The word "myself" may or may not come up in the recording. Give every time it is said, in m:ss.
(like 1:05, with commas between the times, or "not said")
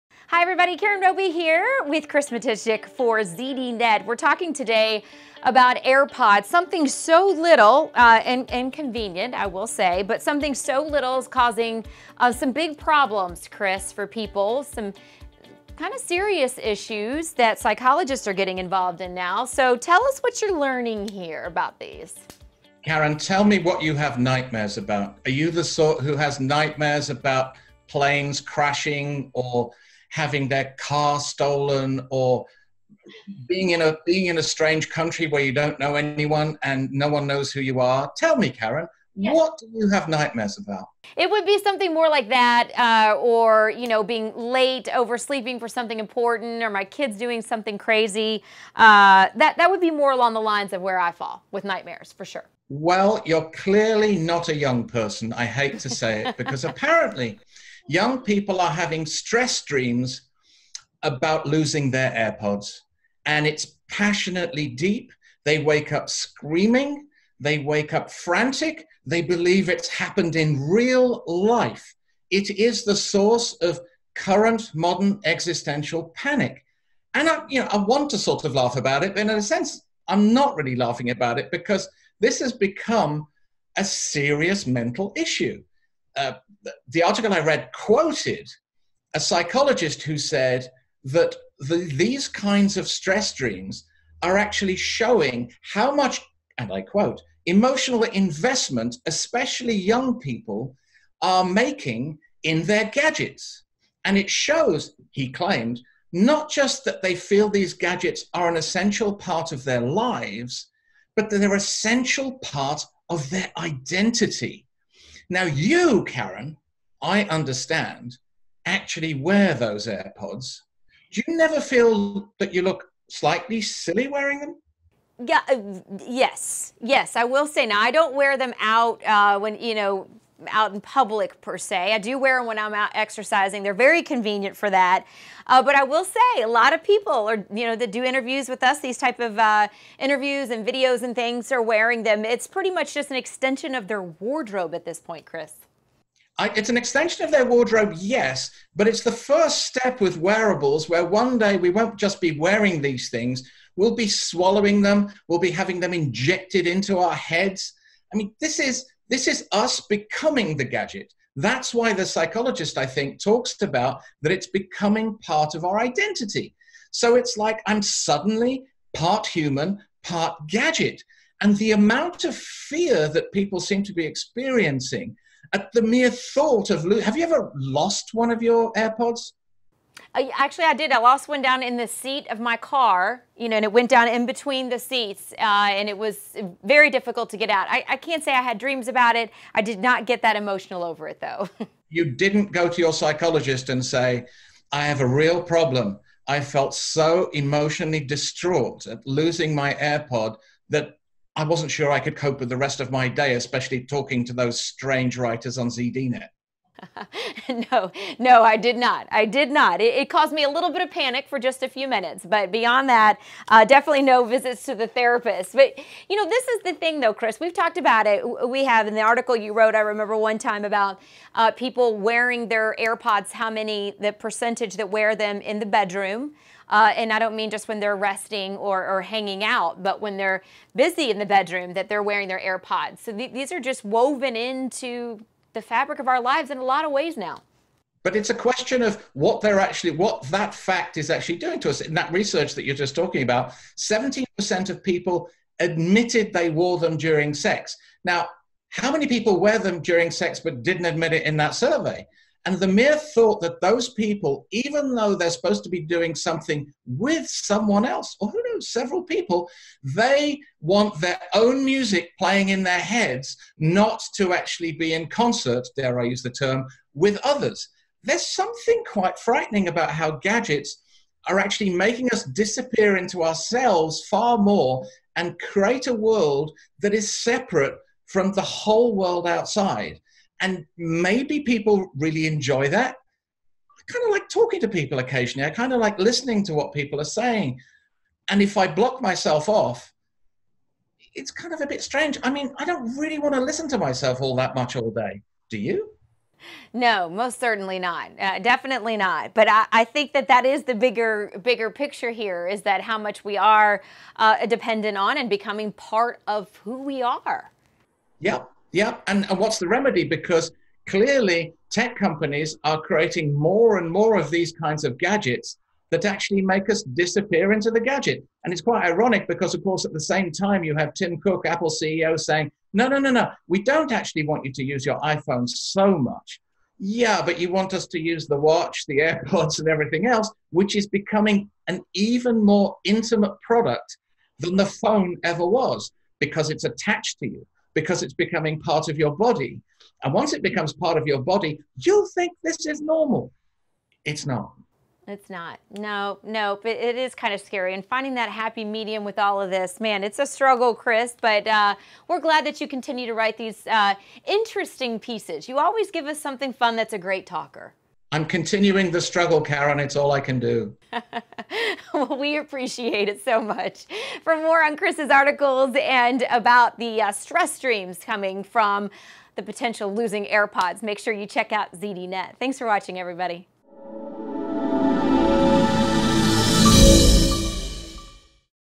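4:49, 4:53.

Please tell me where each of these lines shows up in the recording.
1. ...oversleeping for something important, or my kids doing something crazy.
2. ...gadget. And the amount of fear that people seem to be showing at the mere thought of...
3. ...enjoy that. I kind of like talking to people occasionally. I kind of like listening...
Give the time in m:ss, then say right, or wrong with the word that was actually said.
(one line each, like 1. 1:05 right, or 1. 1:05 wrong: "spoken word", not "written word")
1. 0:44 right
2. 2:50 wrong: "experiencing", not "showing"
3. 4:42 right.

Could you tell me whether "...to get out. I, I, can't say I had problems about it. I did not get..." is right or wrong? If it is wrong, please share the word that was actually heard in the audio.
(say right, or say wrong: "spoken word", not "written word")
wrong: "dreams", not "problems".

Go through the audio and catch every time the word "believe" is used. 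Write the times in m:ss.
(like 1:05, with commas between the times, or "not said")
1:09.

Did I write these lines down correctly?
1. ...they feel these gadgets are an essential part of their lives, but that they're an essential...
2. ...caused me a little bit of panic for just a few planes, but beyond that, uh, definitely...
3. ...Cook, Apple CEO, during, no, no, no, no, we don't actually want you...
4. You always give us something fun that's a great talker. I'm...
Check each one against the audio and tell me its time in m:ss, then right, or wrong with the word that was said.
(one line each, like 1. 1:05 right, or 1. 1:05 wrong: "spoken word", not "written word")
1. 1:47 right
2. 3:30 wrong: "minutes", not "planes"
3. 5:21 wrong: "saying", not "during"
4. 5:55 right.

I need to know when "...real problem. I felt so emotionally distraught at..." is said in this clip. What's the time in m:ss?
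3:15.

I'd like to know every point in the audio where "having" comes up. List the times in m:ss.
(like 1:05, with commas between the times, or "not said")
0:30, 0:58, 2:35.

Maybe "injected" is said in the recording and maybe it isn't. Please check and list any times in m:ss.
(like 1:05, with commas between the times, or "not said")
2:35.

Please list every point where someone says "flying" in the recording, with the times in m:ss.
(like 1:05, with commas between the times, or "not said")
not said.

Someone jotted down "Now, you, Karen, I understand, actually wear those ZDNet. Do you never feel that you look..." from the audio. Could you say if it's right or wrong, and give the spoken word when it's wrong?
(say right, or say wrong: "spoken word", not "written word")
wrong: "AirPods", not "ZDNet".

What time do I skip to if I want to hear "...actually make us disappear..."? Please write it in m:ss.
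5:16.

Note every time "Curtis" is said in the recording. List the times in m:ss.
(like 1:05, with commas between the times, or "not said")
not said.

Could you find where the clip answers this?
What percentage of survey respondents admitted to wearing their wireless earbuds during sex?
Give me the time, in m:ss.
4:03.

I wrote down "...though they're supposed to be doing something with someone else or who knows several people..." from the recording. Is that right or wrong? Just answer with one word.
right.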